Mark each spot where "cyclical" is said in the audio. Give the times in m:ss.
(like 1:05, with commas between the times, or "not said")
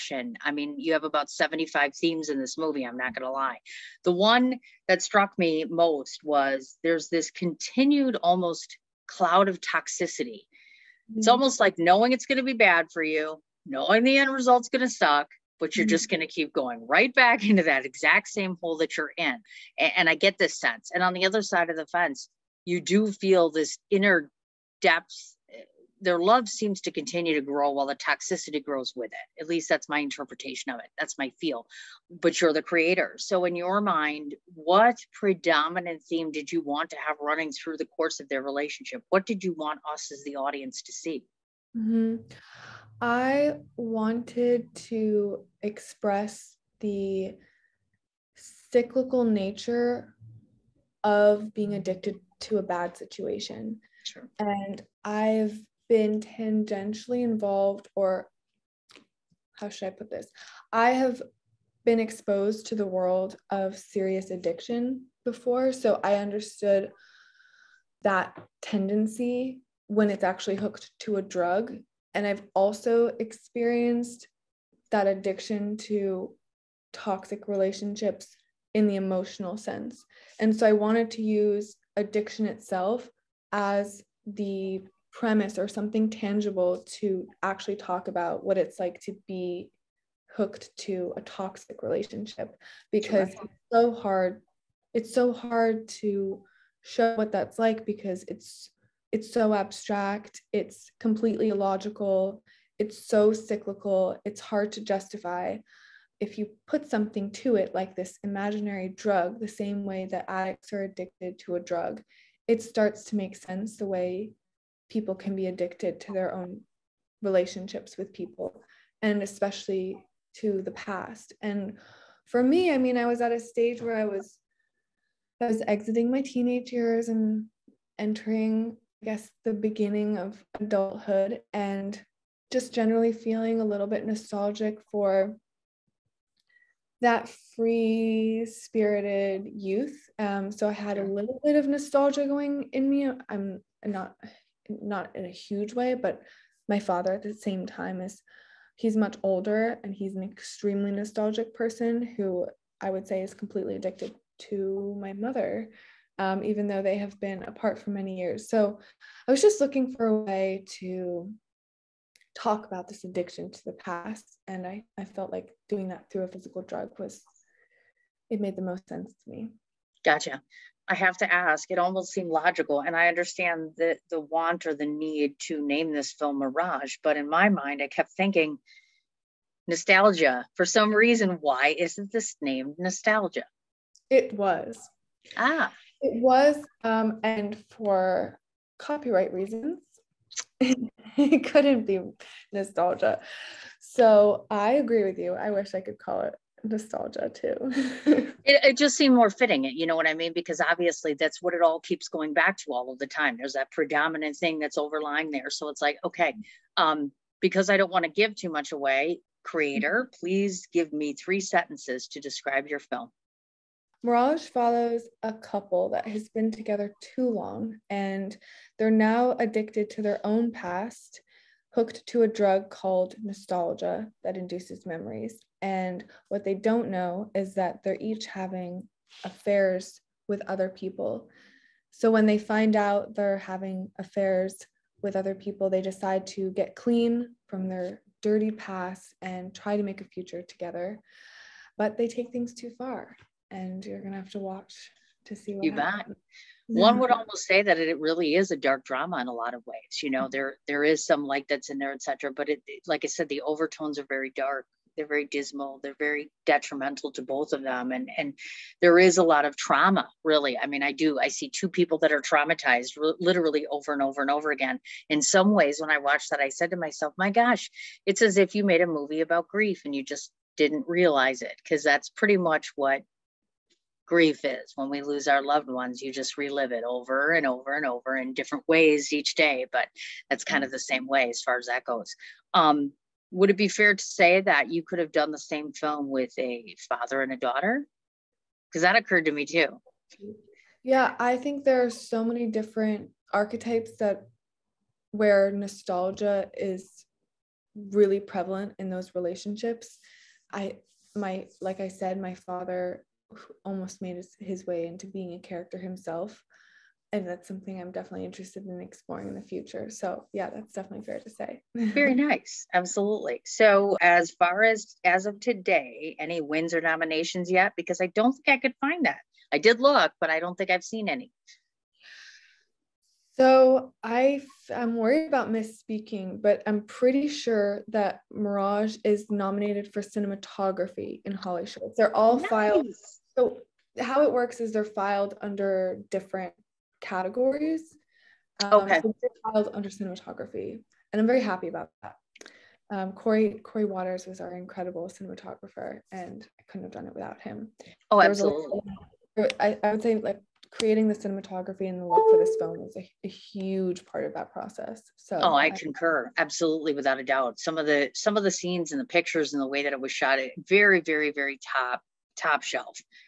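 0:48, 1:43.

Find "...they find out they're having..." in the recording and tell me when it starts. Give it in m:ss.
3:52.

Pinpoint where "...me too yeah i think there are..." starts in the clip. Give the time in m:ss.
4:49.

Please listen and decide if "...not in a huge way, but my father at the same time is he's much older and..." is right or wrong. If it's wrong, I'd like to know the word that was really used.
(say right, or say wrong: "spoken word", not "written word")
right.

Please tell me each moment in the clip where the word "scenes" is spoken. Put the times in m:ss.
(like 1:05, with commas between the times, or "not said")
5:58.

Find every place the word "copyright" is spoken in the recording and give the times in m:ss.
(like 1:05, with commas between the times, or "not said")
3:08.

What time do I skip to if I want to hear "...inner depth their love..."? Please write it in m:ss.
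0:23.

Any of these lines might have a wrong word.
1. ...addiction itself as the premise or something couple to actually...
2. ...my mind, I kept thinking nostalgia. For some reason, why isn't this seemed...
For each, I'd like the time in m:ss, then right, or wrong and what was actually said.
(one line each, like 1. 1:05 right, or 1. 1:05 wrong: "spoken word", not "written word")
1. 1:21 wrong: "tangible", not "couple"
2. 2:57 wrong: "named", not "seemed".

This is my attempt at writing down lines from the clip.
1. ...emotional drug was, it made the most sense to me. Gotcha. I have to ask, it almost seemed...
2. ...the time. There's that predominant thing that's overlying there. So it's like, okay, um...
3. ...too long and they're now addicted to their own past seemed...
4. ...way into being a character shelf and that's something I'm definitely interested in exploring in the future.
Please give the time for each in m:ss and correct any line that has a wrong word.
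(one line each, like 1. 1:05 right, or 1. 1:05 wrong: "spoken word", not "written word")
1. 2:46 wrong: "physical", not "emotional"
2. 3:22 right
3. 3:37 wrong: "hooked", not "seemed"
4. 5:04 wrong: "himself", not "shelf".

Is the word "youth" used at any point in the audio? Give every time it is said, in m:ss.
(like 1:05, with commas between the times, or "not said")
2:19.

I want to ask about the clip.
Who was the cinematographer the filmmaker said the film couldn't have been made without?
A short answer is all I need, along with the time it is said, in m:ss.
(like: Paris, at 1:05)
Corey Waters, at 5:43.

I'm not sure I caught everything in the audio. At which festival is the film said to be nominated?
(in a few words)
HollyShorts.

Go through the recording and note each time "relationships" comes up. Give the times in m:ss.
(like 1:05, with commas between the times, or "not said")
0:38, 1:17, 1:31, 1:57, 4:59.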